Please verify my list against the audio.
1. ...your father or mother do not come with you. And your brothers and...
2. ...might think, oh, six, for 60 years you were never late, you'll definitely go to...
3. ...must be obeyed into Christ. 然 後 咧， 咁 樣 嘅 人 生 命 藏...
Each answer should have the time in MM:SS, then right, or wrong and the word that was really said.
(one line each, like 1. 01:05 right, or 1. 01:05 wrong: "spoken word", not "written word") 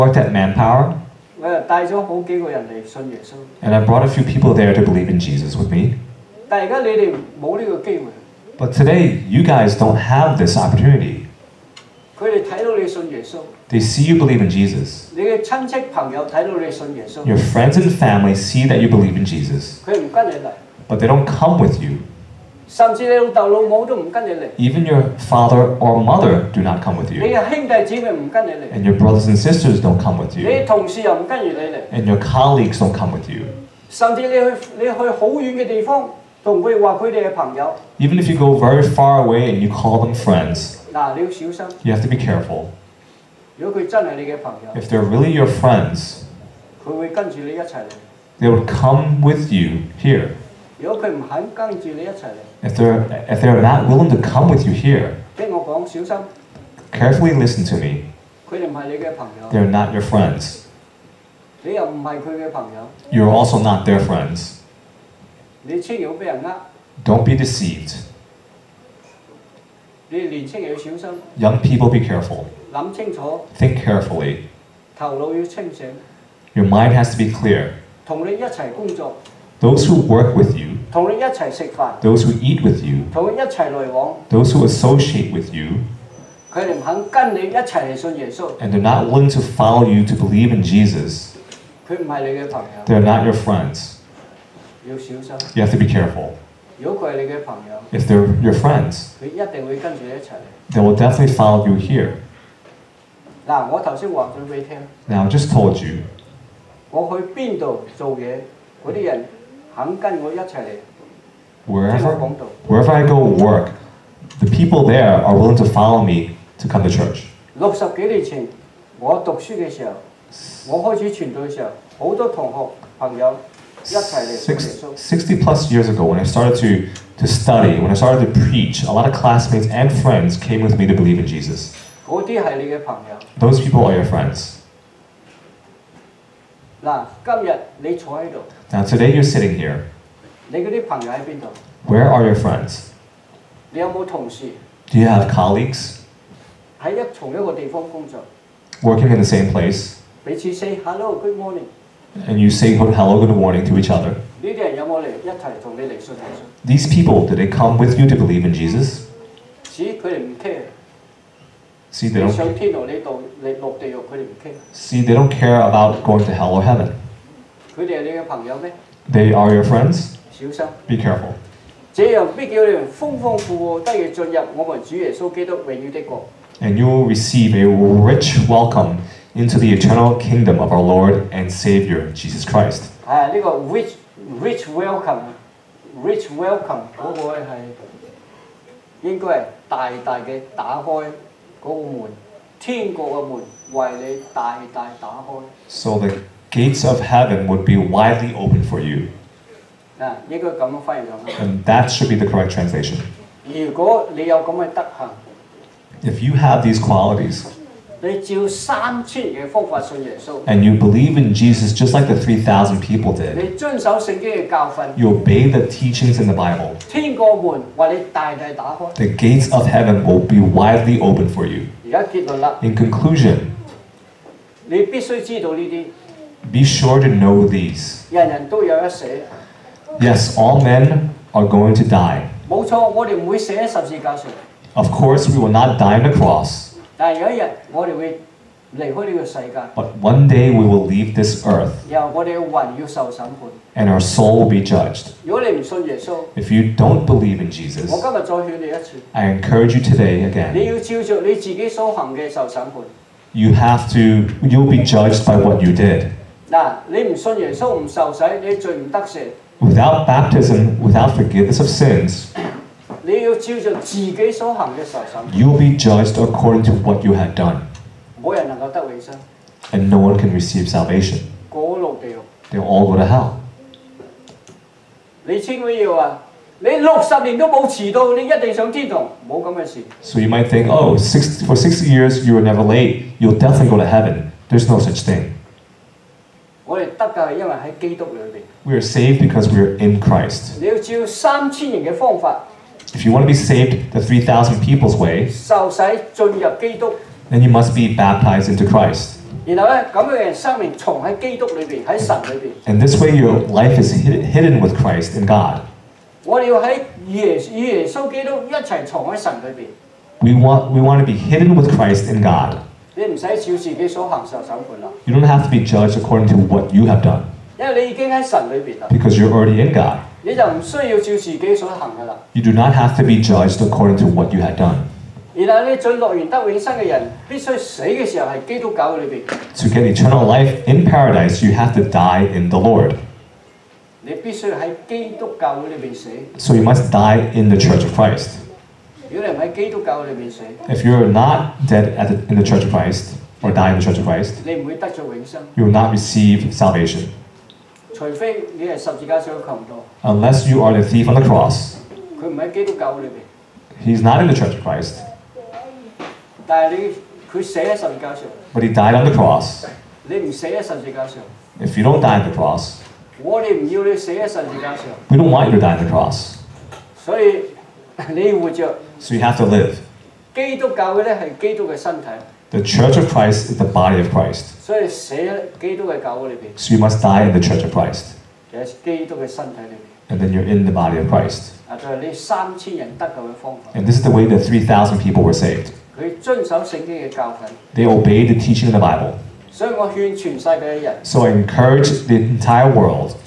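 1. 00:24 right
2. 04:40 right
3. 04:57 wrong: "baptized", not "obeyed".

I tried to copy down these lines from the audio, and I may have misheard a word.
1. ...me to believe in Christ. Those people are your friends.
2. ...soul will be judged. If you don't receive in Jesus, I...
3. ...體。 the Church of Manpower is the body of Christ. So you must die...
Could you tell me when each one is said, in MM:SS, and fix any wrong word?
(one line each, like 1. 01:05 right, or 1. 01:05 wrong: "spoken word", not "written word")
1. 02:10 wrong: "Jesus", not "Christ"
2. 04:04 wrong: "believe", not "receive"
3. 06:12 wrong: "Christ", not "Manpower".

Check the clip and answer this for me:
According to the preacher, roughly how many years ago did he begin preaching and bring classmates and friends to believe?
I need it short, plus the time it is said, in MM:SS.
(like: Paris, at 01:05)
60 plus years, at 02:04.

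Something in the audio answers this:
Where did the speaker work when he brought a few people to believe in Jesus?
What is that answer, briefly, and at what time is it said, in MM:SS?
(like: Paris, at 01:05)
Manpower, at 00:00.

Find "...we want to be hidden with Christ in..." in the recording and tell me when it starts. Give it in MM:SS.
05:10.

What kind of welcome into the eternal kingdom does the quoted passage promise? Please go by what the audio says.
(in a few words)
rich welcome.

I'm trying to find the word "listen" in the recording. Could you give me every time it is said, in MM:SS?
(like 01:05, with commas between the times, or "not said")
00:57.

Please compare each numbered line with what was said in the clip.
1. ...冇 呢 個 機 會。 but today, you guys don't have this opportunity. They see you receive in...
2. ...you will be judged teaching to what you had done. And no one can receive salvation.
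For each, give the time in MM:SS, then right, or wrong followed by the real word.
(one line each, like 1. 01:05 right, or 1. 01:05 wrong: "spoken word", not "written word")
1. 00:07 wrong: "believe", not "receive"
2. 04:23 wrong: "according", not "teaching".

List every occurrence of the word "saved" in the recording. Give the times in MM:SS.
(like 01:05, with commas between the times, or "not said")
04:48, 04:53, 06:25.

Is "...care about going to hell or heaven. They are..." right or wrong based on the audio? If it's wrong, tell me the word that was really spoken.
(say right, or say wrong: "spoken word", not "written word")
right.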